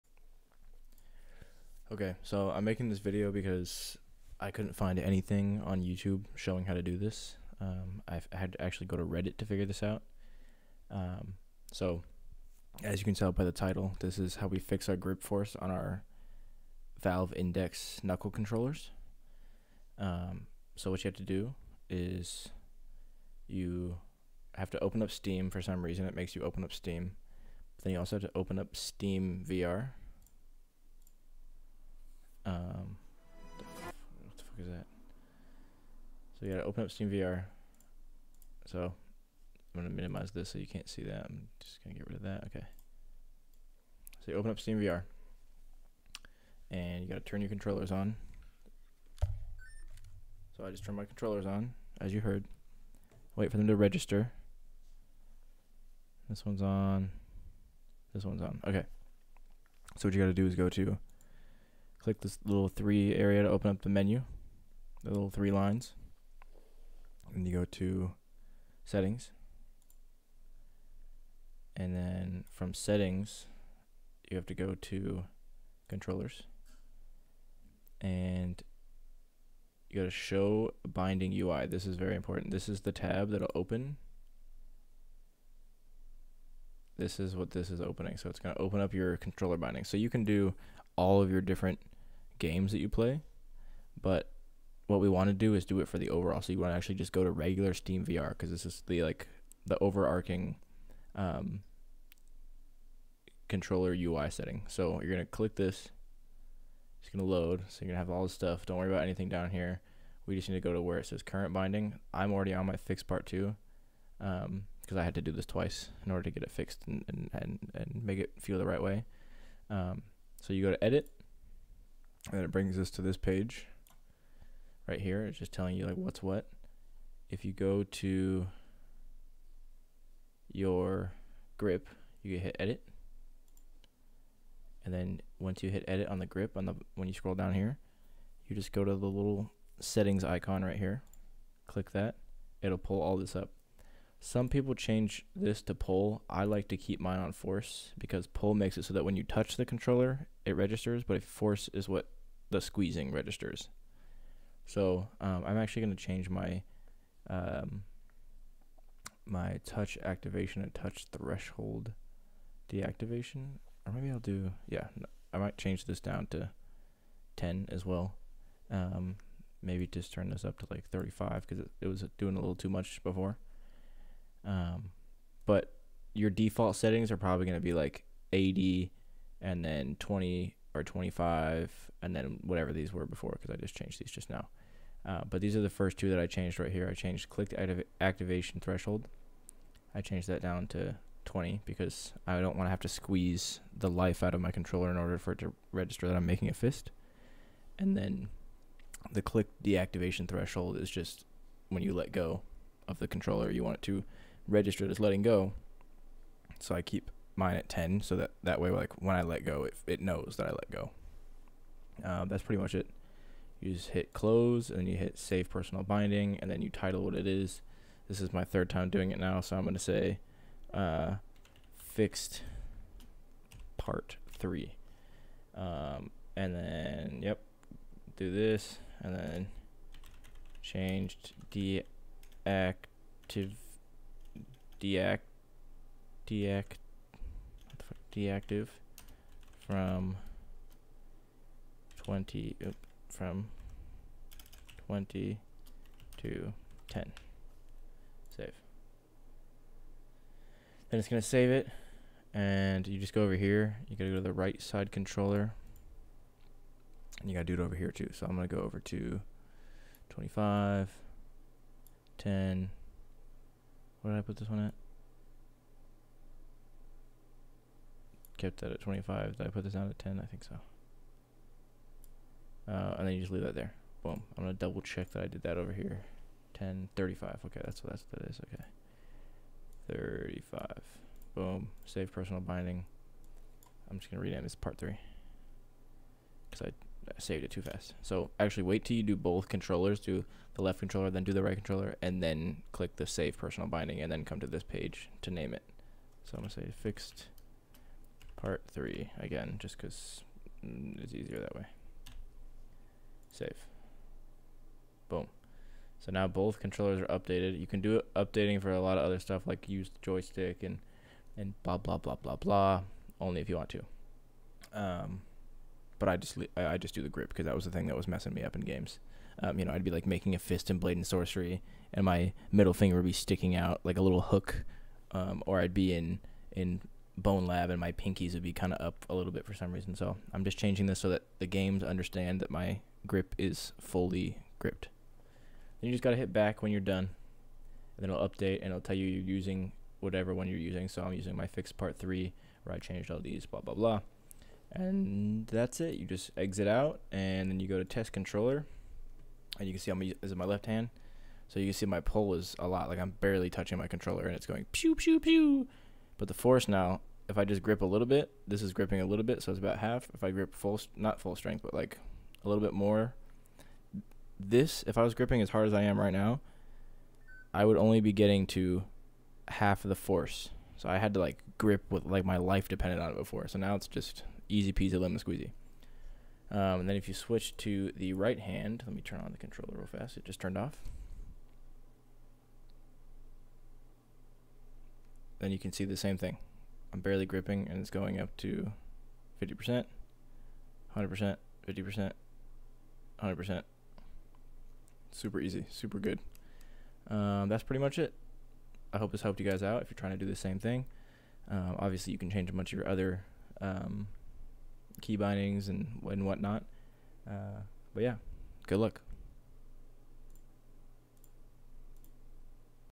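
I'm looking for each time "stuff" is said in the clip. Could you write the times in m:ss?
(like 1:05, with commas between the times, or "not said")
1:48, 5:09.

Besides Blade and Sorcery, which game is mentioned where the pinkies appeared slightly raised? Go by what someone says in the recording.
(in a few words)
Bonelab.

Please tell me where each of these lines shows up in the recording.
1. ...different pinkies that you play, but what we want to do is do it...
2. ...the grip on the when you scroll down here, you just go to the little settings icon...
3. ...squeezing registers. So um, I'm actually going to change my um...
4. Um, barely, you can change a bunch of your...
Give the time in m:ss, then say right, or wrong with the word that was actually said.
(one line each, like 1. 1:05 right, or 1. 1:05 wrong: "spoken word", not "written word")
1. 1:31 wrong: "games", not "pinkies"
2. 2:16 right
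3. 2:32 right
4. 6:41 wrong: "obviously", not "barely".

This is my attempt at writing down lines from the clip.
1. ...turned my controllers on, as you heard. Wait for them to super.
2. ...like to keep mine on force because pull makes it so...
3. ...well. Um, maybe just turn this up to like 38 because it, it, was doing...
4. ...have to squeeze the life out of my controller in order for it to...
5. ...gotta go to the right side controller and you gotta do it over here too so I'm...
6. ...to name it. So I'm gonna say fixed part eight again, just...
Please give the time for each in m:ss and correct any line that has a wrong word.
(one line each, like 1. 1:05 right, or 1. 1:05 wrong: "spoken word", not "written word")
1. 0:50 wrong: "register", not "super"
2. 2:26 right
3. 2:47 wrong: "35", not "38"
4. 3:12 right
5. 4:13 right
6. 4:55 wrong: "three", not "eight".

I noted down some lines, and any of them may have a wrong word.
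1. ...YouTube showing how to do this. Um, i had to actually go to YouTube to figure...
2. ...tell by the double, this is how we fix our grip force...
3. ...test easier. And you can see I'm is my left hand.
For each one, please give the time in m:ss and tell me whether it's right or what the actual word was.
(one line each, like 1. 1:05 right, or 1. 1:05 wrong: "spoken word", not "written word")
1. 0:05 wrong: "Reddit", not "YouTube"
2. 0:13 wrong: "title", not "double"
3. 5:47 wrong: "controller", not "easier".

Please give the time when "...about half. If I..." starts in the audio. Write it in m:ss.
5:59.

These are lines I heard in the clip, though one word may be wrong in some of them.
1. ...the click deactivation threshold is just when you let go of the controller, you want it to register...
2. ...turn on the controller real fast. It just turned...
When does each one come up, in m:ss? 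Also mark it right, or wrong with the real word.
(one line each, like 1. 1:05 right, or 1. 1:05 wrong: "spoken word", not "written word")
1. 3:19 right
2. 6:19 right.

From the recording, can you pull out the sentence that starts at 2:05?
It's just telling you like what's what.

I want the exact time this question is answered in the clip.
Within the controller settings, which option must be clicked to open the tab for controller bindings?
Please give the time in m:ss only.
1:20.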